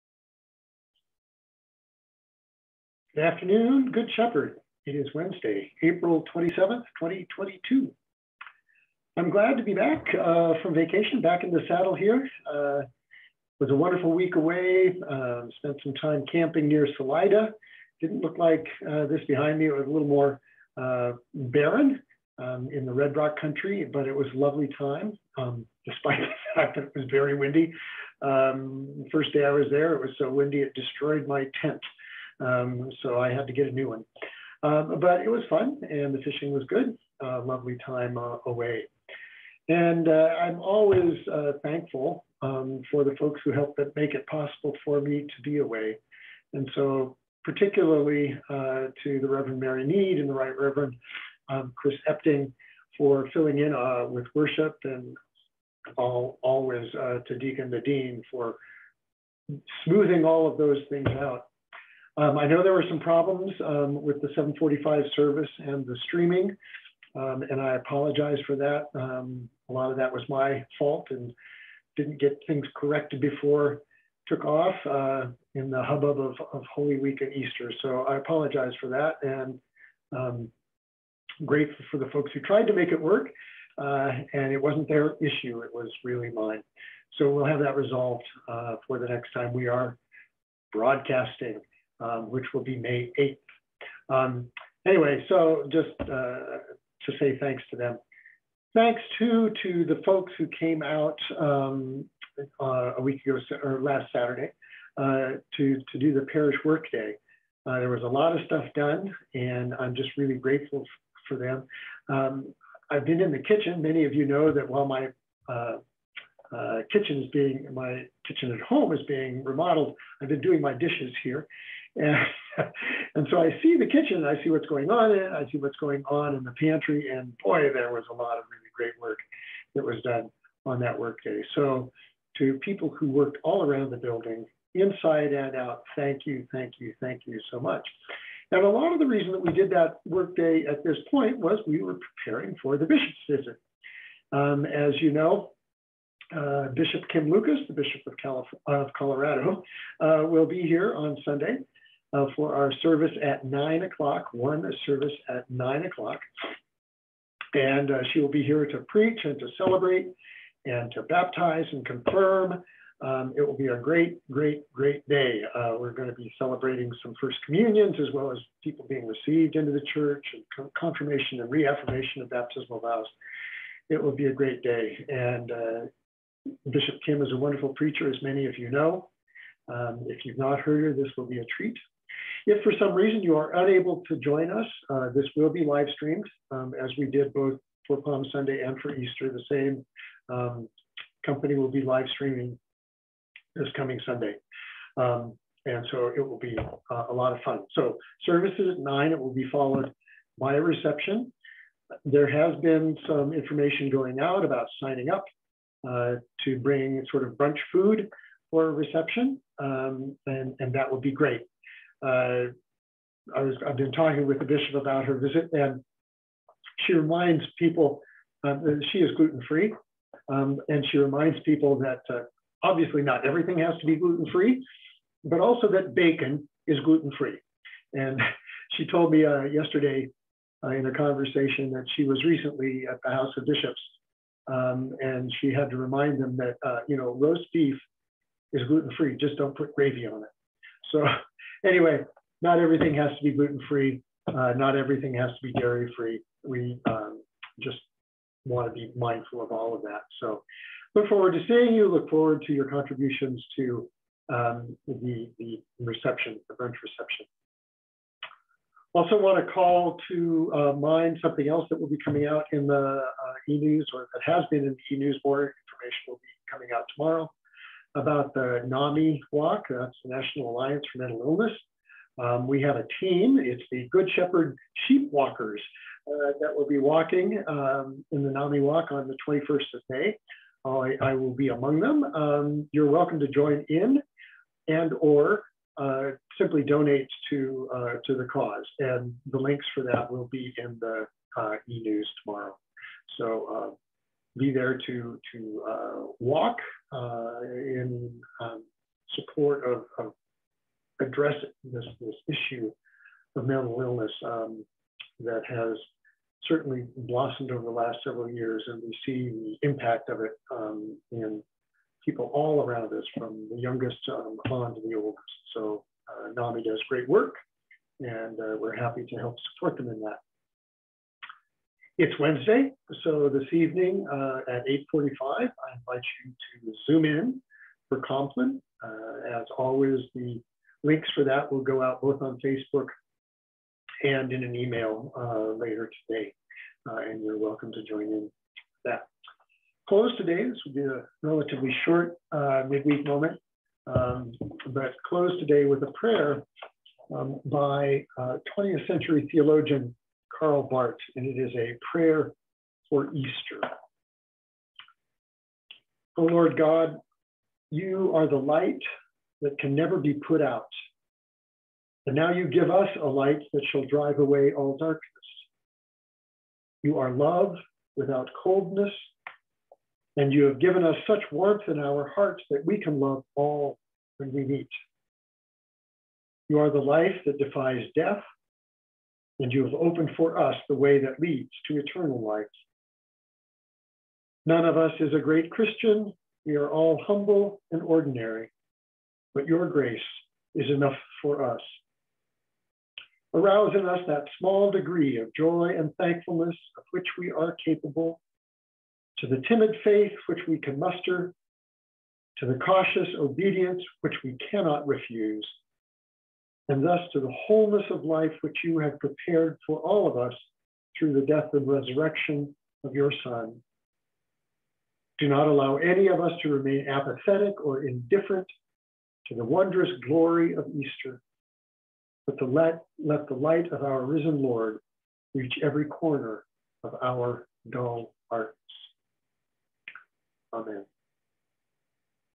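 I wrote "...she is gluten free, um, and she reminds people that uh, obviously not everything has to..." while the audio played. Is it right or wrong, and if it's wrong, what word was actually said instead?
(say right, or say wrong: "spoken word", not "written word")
right.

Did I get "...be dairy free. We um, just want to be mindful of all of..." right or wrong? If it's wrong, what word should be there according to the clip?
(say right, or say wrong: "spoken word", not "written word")
right.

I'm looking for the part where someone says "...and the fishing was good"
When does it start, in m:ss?
0:35.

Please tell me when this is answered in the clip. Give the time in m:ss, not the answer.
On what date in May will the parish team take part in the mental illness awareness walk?
4:39.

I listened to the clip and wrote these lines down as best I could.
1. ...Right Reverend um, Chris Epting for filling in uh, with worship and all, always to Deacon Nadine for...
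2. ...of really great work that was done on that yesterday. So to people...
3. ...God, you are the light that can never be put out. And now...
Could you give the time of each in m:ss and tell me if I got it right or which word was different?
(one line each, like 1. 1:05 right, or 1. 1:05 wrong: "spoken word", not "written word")
1. 0:50 right
2. 2:08 wrong: "workday", not "yesterday"
3. 5:56 right.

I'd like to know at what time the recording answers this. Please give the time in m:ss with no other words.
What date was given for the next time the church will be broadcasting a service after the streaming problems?
1:32.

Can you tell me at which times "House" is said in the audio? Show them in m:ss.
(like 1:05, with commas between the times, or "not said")
3:53.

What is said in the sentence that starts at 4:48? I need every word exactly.
And the links for that will be in the uh, e-news tomorrow.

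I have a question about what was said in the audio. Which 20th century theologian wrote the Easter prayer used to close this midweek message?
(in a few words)
Karl Barth.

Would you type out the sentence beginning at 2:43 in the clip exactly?
Um, it will be a great, great, great day.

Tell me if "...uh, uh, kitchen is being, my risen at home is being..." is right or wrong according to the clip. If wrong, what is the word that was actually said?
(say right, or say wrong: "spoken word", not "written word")
wrong: "kitchen", not "risen".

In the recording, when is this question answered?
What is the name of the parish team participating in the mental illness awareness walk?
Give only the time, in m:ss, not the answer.
4:33.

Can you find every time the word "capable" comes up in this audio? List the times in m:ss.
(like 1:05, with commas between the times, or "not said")
6:37.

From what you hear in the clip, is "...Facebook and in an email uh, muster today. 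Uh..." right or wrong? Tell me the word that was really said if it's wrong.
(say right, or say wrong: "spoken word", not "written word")
wrong: "later", not "muster".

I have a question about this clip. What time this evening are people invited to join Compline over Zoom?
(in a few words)
8:45.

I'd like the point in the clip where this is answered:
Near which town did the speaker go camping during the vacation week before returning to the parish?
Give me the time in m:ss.
0:16.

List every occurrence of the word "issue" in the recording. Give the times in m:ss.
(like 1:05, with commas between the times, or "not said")
1:25, 5:02.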